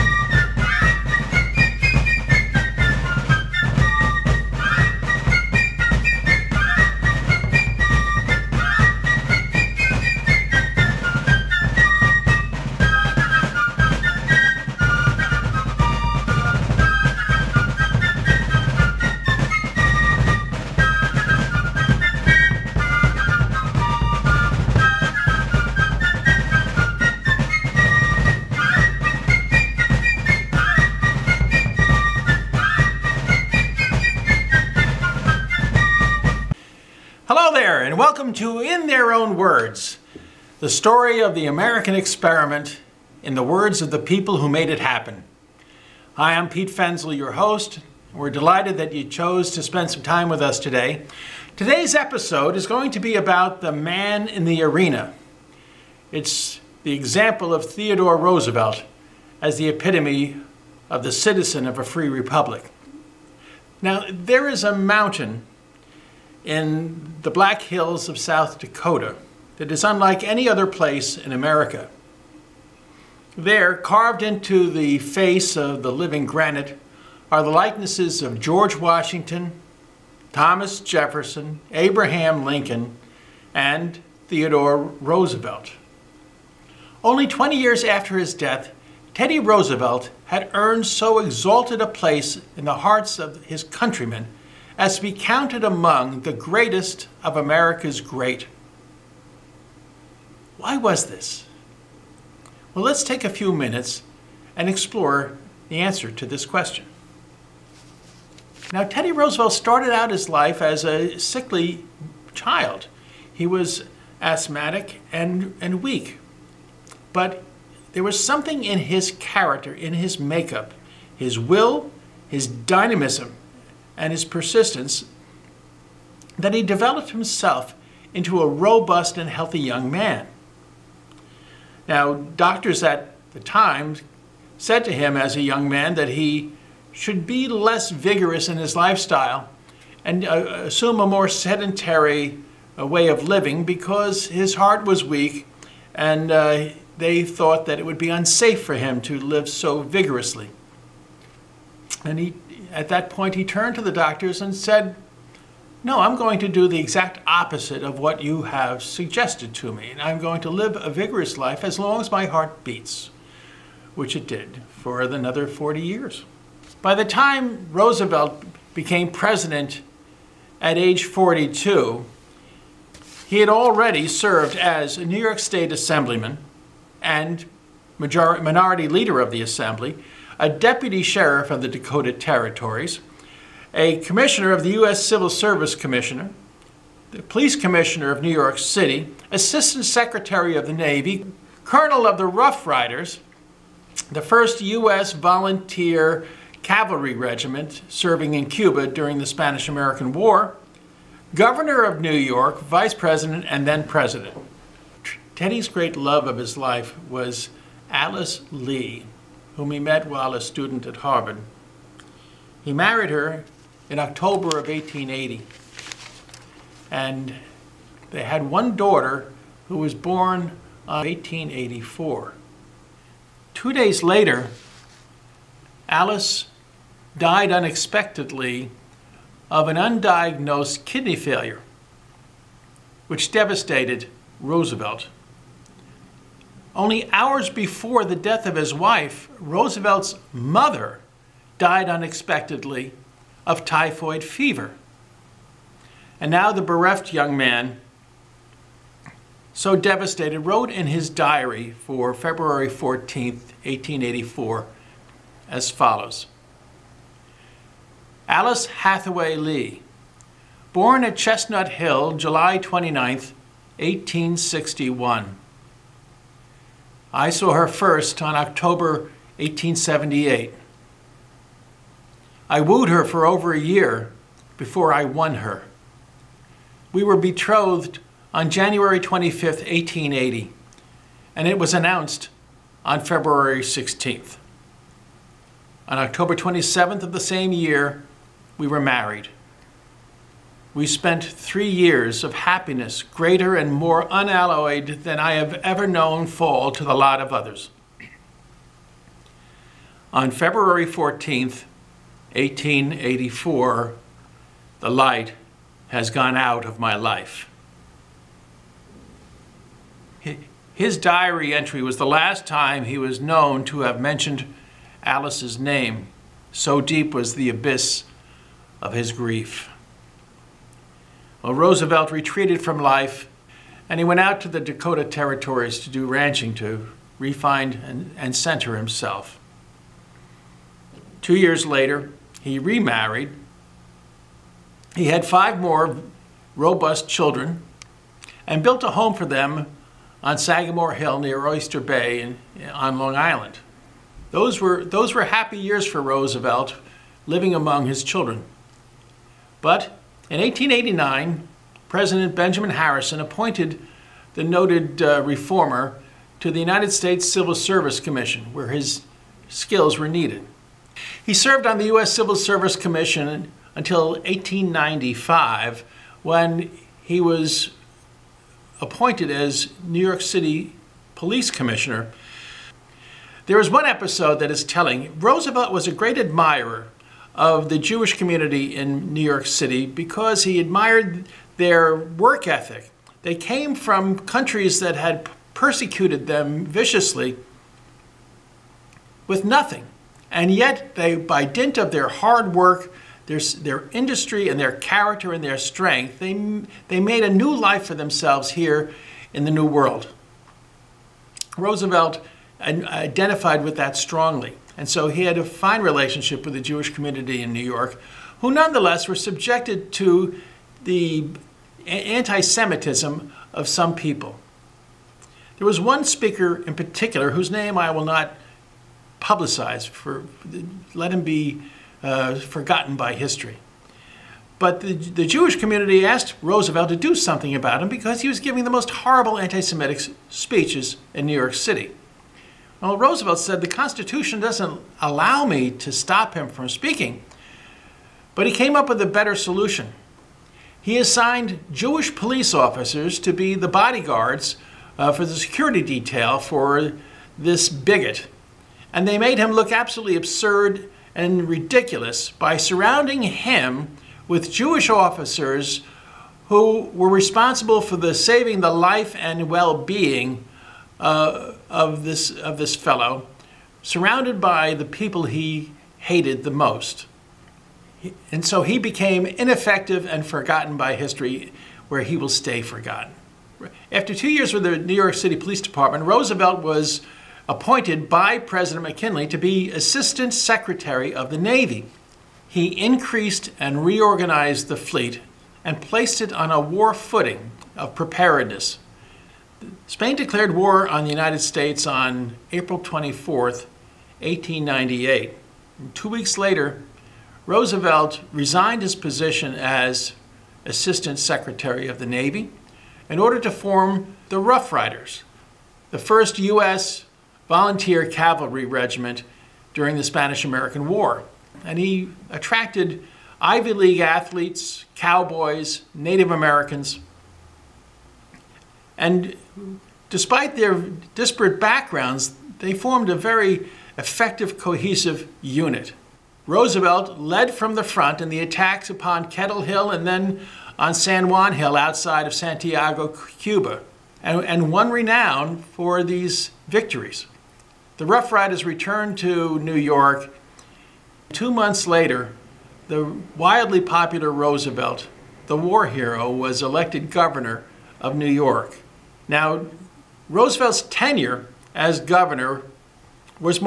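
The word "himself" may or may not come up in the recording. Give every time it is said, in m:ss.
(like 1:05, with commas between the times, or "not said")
2:07, 5:28.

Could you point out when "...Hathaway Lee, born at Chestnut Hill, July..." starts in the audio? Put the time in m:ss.
4:18.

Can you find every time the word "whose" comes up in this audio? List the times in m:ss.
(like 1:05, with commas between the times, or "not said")
6:57.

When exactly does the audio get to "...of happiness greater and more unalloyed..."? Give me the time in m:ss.
4:52.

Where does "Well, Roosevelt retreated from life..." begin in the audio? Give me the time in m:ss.
5:21.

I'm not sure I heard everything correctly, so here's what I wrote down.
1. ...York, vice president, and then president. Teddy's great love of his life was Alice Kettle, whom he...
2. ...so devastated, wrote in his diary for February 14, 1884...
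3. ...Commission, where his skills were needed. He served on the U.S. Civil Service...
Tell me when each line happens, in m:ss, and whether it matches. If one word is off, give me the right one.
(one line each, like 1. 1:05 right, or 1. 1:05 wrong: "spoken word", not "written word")
1. 3:22 wrong: "Lee", not "Kettle"
2. 4:09 right
3. 5:58 right.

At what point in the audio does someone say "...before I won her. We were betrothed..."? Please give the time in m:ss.
4:34.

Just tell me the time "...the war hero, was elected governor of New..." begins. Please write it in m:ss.
9:05.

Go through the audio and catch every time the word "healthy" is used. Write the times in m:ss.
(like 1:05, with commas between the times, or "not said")
2:09.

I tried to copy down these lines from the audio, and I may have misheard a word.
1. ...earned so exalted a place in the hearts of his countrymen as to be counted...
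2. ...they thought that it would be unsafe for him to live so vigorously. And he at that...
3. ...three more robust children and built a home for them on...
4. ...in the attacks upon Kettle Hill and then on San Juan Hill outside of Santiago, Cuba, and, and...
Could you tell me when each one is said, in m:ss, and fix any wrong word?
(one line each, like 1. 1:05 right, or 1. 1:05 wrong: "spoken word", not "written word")
1. 1:30 right
2. 2:26 right
3. 5:35 wrong: "five", not "three"
4. 8:48 right.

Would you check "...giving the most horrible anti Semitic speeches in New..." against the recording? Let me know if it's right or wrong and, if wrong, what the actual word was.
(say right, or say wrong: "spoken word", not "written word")
right.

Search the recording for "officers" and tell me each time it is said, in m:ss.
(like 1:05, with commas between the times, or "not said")
7:22, 7:34.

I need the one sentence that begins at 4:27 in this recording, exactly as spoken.
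I saw her first on October 1878.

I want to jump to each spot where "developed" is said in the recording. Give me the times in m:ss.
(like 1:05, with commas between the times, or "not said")
2:06.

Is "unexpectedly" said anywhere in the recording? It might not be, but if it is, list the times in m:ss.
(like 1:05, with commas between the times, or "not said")
3:47, 4:01.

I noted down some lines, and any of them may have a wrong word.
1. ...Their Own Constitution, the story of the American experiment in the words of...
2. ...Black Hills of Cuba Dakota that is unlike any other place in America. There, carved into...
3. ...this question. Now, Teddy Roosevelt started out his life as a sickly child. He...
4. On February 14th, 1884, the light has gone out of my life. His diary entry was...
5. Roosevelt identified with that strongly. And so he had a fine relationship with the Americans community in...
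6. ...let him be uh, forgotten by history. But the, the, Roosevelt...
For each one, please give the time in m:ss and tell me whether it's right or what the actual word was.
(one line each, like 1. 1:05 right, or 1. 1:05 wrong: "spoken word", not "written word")
1. 0:38 wrong: "Words", not "Constitution"
2. 1:07 wrong: "South", not "Cuba"
3. 1:46 right
4. 5:00 right
5. 6:41 wrong: "Jewish", not "Americans"
6. 7:00 wrong: "Jewish", not "Roosevelt".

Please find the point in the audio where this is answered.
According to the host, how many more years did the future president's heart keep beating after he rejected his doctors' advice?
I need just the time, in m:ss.
2:45.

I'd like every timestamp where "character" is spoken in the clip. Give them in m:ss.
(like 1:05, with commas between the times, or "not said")
1:59, 6:34.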